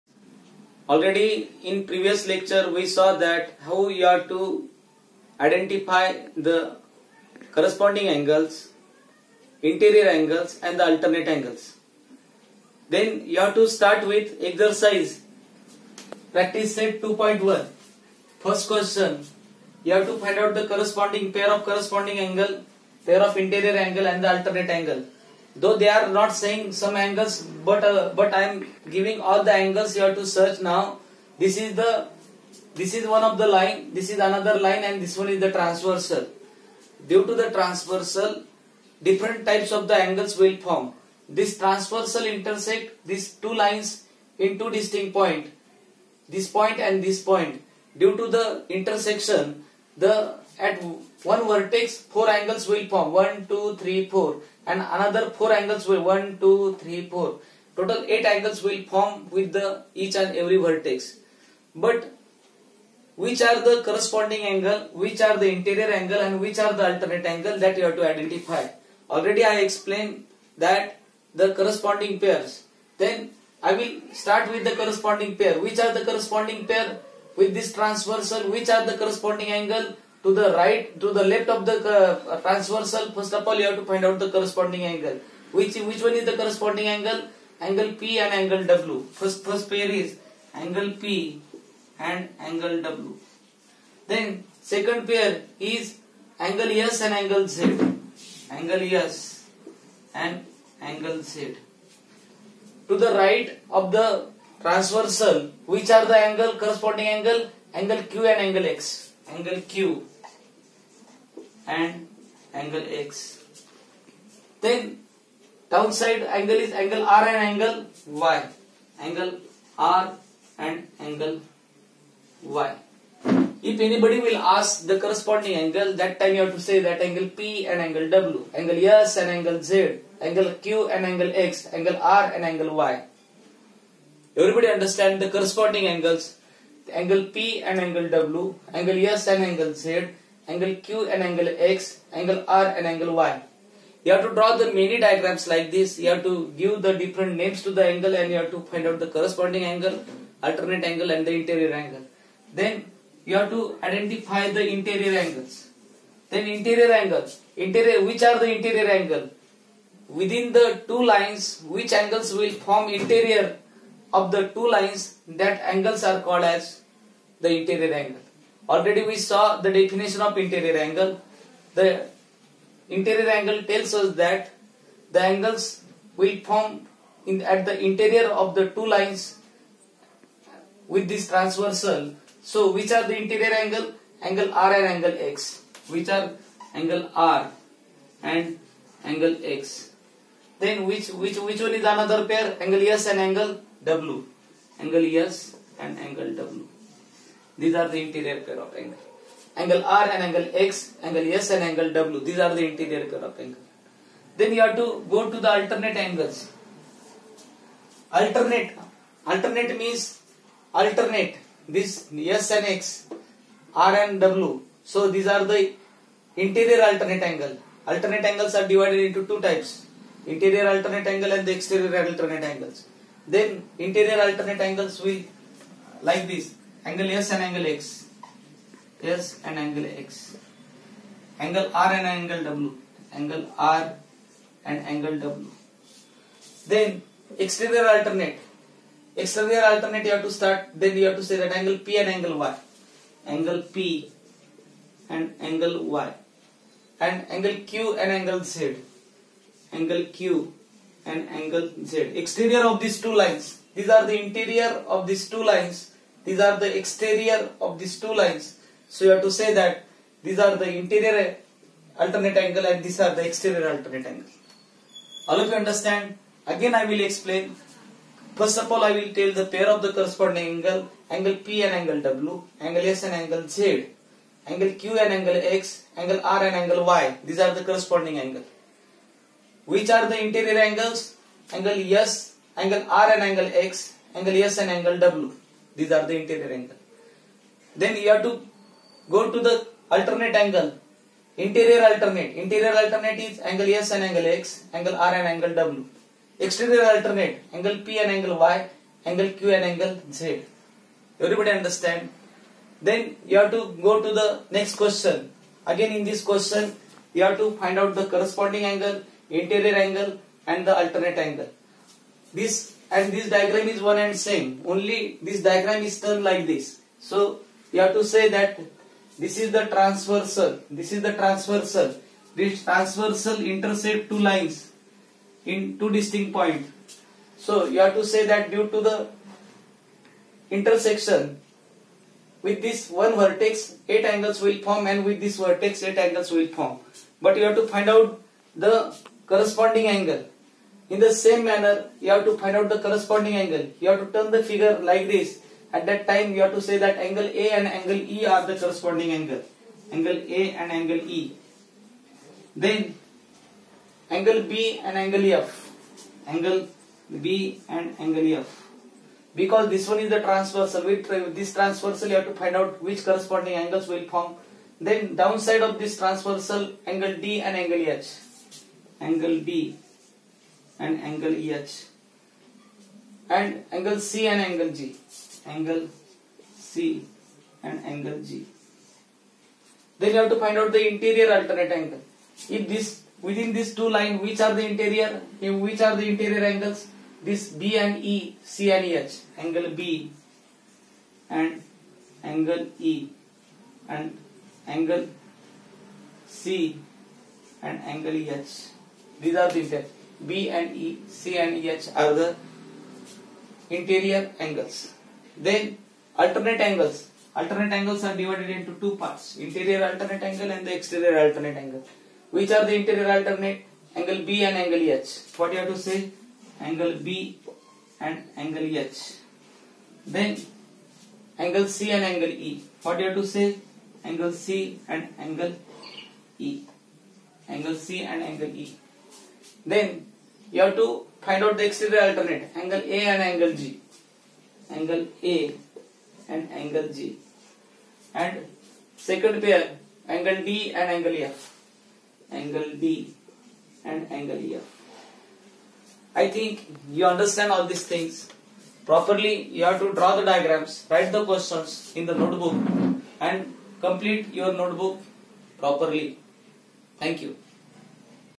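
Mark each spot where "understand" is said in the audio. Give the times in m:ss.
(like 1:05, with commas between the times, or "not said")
2:14, 4:25, 5:01, 7:27.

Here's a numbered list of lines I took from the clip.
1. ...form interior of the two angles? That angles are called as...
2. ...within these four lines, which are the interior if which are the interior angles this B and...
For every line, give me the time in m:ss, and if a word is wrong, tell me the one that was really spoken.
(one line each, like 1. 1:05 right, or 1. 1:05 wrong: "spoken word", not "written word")
1. 2:42 wrong: "lines", not "angles"
2. 6:23 wrong: "two", not "four".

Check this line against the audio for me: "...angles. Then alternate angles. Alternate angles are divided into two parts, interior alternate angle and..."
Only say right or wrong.
right.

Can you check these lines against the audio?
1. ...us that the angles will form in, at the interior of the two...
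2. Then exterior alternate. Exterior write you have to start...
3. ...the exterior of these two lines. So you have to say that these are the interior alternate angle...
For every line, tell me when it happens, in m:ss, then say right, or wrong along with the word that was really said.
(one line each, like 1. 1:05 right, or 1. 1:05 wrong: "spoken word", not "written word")
1. 2:53 right
2. 3:56 wrong: "alternate", not "write"
3. 4:16 right.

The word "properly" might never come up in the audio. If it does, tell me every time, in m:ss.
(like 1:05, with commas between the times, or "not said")
7:28, 7:35.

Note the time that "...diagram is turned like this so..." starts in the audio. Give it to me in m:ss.
5:15.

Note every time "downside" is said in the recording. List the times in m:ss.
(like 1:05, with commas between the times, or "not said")
1:55, 6:05.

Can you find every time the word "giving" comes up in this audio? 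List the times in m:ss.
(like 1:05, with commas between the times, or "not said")
0:28.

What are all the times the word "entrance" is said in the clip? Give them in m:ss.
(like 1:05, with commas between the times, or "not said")
not said.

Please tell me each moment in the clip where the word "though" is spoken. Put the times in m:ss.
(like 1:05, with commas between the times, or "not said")
0:25.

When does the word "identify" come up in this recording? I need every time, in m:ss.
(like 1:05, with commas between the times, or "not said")
0:05, 1:08, 2:33.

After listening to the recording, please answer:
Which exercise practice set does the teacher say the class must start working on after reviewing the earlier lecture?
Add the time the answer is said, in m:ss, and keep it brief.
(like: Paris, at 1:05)
2.1, at 0:16.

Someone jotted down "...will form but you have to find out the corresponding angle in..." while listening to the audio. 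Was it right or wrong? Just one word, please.
right.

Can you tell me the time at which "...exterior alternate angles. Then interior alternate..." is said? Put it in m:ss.
3:41.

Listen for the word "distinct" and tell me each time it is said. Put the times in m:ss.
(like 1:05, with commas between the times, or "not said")
0:44, 5:25.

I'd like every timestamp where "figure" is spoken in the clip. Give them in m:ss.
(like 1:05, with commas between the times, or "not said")
5:44.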